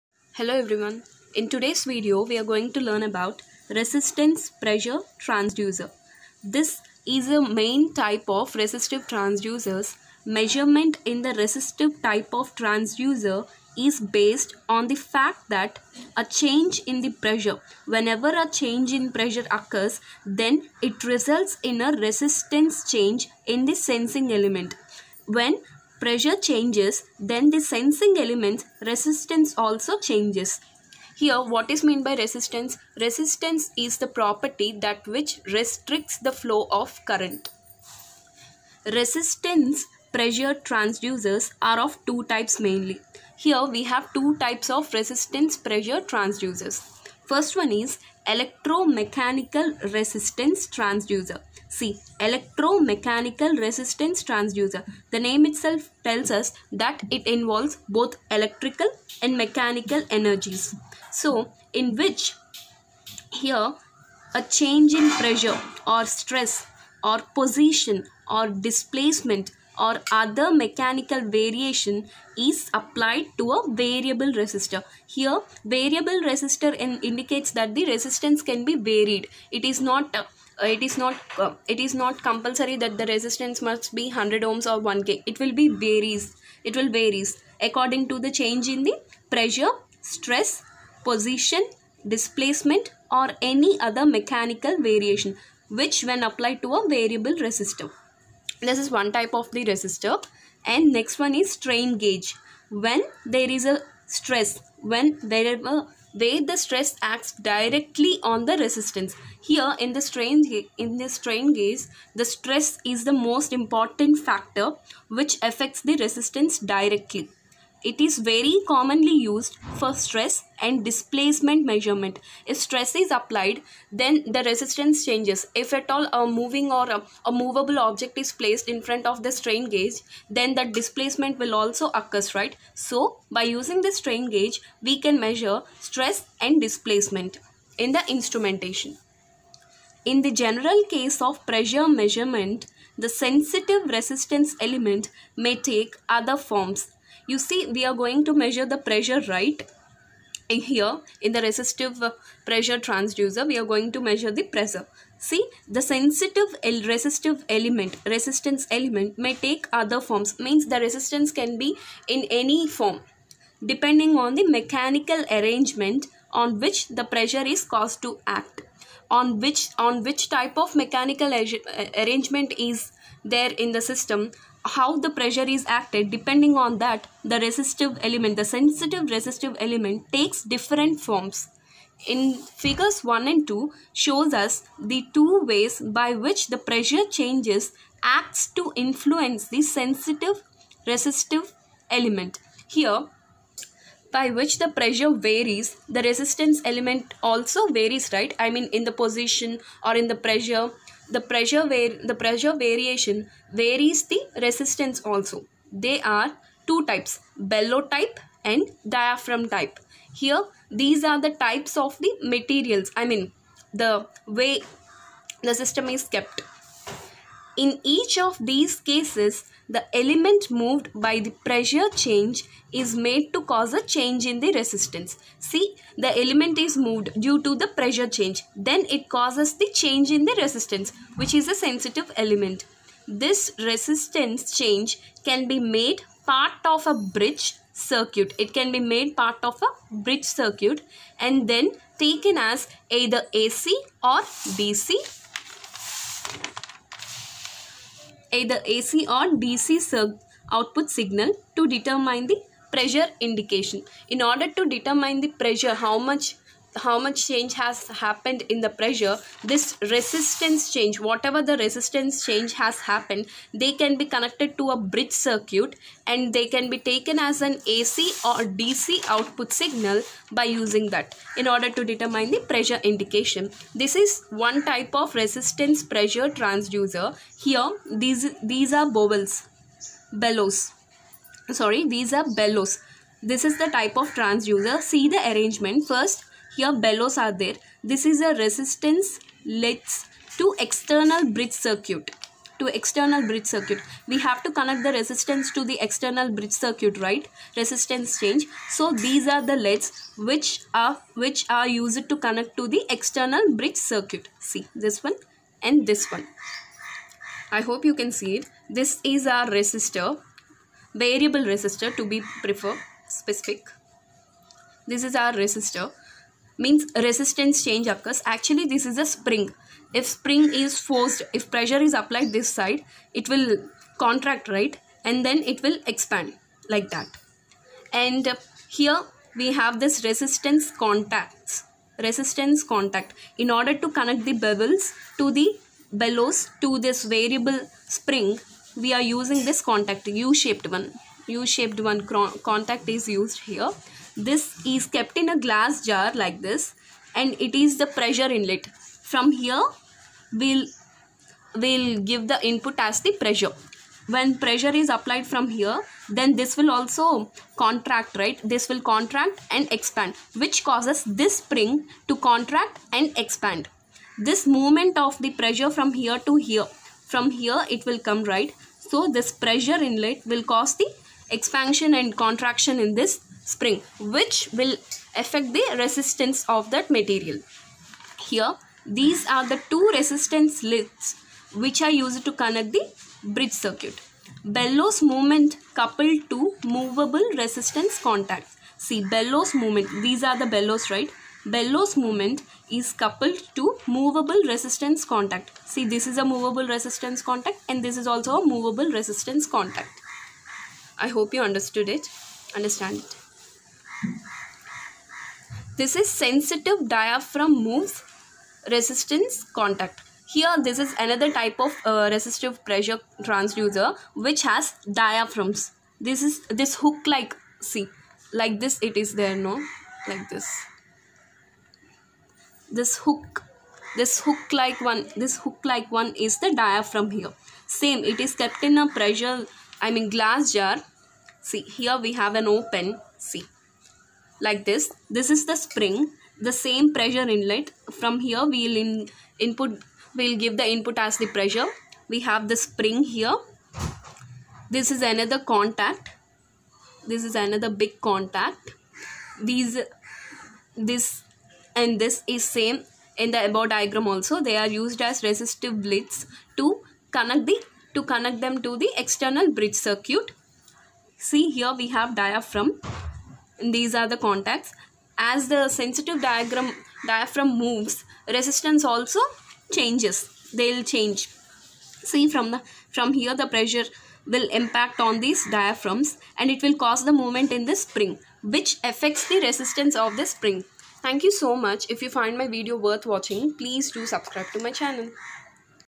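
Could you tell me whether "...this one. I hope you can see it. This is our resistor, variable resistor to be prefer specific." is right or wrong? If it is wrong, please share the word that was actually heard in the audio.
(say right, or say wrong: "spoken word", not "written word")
right.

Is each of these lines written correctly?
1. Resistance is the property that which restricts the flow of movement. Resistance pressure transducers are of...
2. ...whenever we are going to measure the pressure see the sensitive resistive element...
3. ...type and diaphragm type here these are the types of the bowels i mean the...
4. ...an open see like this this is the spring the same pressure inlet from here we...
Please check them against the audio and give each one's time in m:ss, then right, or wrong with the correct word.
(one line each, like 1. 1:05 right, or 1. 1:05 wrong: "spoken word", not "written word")
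1. 0:32 wrong: "current", not "movement"
2. 2:32 wrong: "transducer", not "whenever"
3. 3:27 wrong: "materials", not "bowels"
4. 7:12 right.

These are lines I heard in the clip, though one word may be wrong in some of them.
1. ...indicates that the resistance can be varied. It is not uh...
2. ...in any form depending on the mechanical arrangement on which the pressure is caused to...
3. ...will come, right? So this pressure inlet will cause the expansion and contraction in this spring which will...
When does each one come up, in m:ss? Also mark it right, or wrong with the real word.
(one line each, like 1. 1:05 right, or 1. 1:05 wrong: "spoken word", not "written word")
1. 1:17 right
2. 2:42 right
3. 6:07 right.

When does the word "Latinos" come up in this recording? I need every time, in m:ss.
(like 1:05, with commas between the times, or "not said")
not said.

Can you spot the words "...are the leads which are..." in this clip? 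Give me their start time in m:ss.
4:59.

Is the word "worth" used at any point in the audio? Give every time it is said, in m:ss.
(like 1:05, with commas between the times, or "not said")
8:02.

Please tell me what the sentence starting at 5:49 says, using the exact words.
From here, we'll, we'll give the input as the pressure.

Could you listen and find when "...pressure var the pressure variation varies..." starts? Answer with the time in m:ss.
3:21.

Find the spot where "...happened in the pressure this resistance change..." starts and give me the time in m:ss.
4:17.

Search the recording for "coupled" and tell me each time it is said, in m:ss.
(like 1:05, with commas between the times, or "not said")
6:25, 6:32.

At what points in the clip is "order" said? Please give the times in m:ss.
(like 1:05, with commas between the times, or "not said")
4:14, 4:31, 5:33.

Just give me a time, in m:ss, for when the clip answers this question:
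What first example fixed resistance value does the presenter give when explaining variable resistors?
1:24.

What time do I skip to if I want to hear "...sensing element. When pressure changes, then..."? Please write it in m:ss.
0:23.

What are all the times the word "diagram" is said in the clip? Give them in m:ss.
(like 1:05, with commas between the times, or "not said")
7:33, 7:46.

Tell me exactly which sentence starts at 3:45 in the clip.
See, the element is moved due to the pressure change.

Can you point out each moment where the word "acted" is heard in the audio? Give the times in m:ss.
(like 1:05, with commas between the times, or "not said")
2:55.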